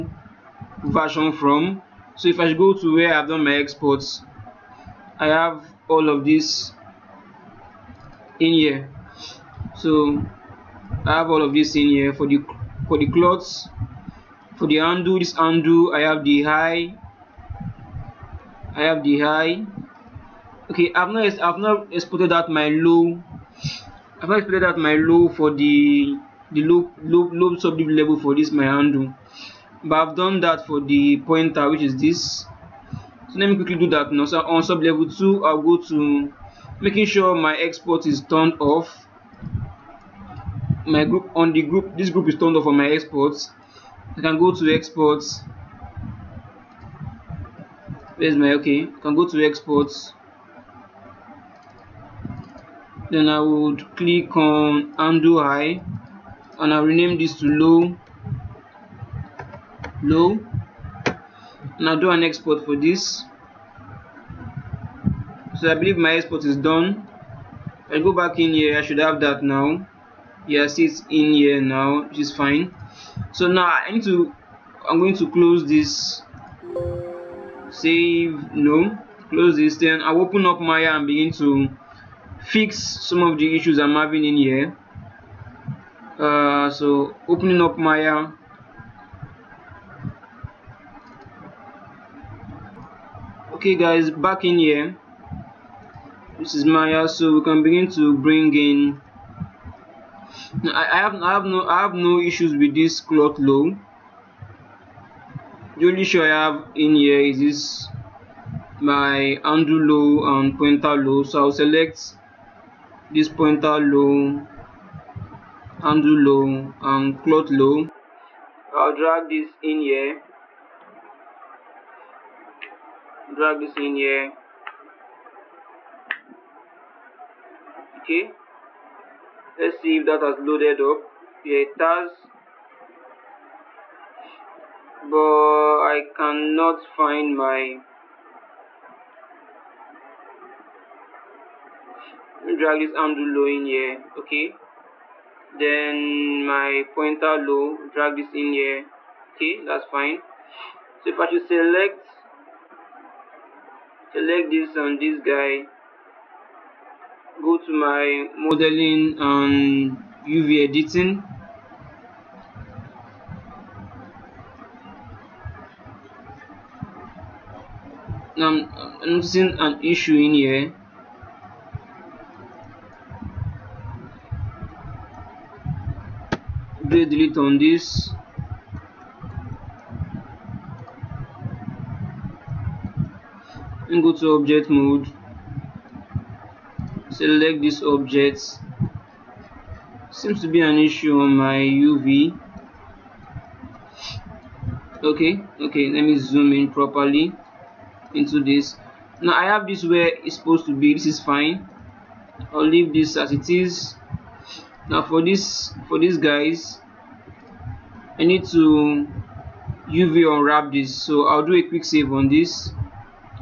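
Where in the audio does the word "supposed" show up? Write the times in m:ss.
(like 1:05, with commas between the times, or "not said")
3:20.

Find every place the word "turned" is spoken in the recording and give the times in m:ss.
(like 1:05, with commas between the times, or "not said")
0:38, 0:42.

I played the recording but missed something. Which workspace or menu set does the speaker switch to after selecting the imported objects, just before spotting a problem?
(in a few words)
modeling and UV editing.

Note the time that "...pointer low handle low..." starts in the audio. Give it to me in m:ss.
1:53.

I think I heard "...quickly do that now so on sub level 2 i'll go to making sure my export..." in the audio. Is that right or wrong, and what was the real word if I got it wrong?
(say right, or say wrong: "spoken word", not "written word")
right.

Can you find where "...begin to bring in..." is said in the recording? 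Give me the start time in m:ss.
1:37.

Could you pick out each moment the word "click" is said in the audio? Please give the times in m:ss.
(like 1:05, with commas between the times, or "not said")
0:53.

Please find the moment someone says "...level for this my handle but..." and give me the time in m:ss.
0:27.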